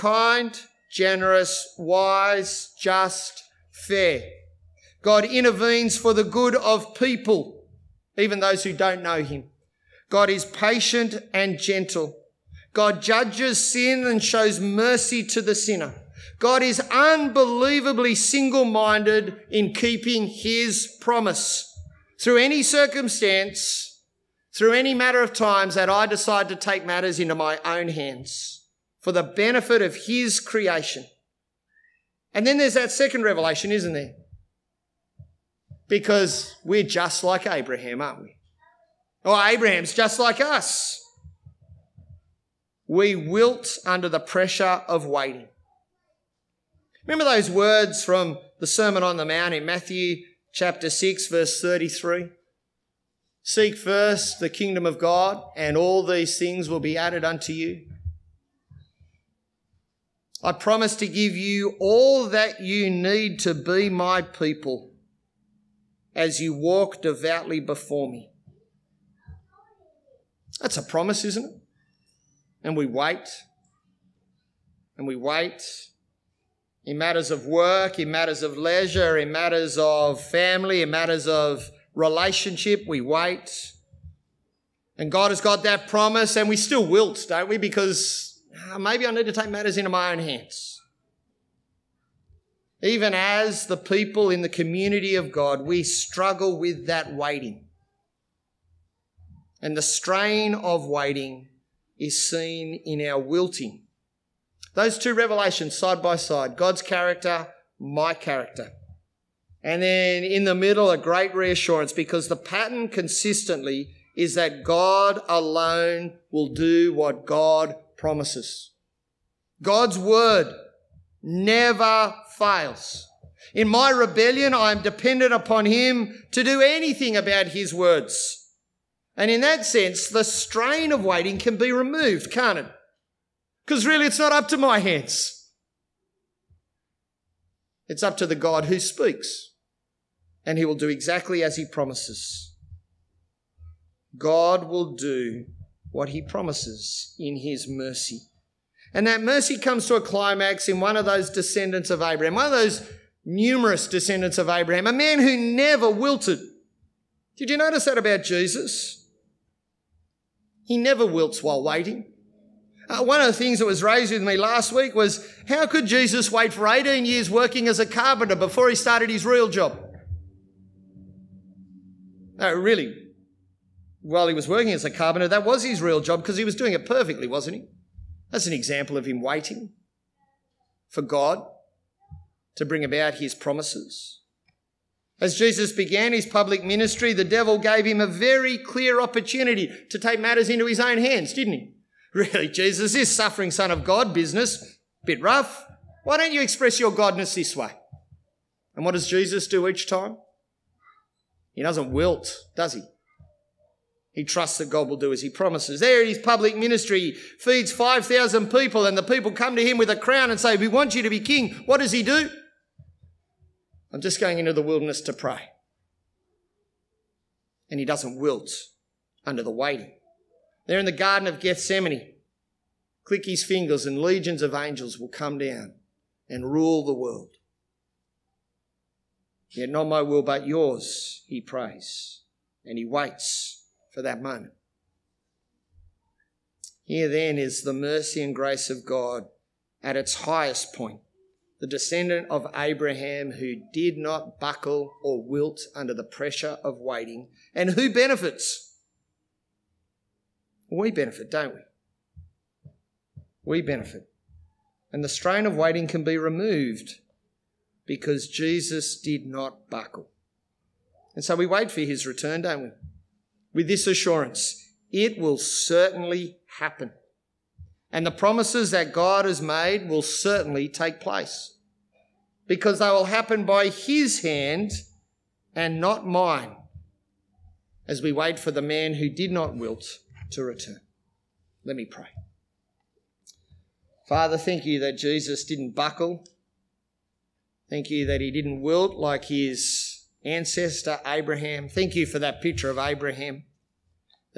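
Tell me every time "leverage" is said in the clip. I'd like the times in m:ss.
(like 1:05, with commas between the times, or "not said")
not said.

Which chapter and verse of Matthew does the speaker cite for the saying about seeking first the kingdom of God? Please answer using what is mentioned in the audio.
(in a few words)
Chapter 6, verse 33.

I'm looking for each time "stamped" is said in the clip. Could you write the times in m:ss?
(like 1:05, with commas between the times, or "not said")
not said.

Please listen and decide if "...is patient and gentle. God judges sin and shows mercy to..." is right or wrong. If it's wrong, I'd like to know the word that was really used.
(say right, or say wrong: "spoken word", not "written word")
right.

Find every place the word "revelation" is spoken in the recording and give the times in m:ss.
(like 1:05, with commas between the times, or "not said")
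0:33, 1:45.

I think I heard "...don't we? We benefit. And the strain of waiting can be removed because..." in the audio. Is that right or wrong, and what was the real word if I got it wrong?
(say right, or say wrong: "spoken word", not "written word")
right.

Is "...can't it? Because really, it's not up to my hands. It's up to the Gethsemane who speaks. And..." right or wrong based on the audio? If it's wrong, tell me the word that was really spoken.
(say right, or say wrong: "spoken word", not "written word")
wrong: "God", not "Gethsemane".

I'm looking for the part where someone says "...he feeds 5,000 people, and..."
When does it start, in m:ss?
3:26.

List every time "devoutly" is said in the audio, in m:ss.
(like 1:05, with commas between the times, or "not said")
1:07.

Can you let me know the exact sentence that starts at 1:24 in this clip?
And God has got that promise, and we still wilt, don't we?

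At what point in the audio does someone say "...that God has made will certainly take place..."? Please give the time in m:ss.
4:28.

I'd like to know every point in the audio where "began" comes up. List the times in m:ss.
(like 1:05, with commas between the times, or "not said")
3:05.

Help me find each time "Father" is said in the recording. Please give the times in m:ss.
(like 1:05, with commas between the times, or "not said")
4:44.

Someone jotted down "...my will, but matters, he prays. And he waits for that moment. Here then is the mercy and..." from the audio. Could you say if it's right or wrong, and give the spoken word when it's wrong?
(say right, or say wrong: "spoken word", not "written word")
wrong: "yours", not "matters".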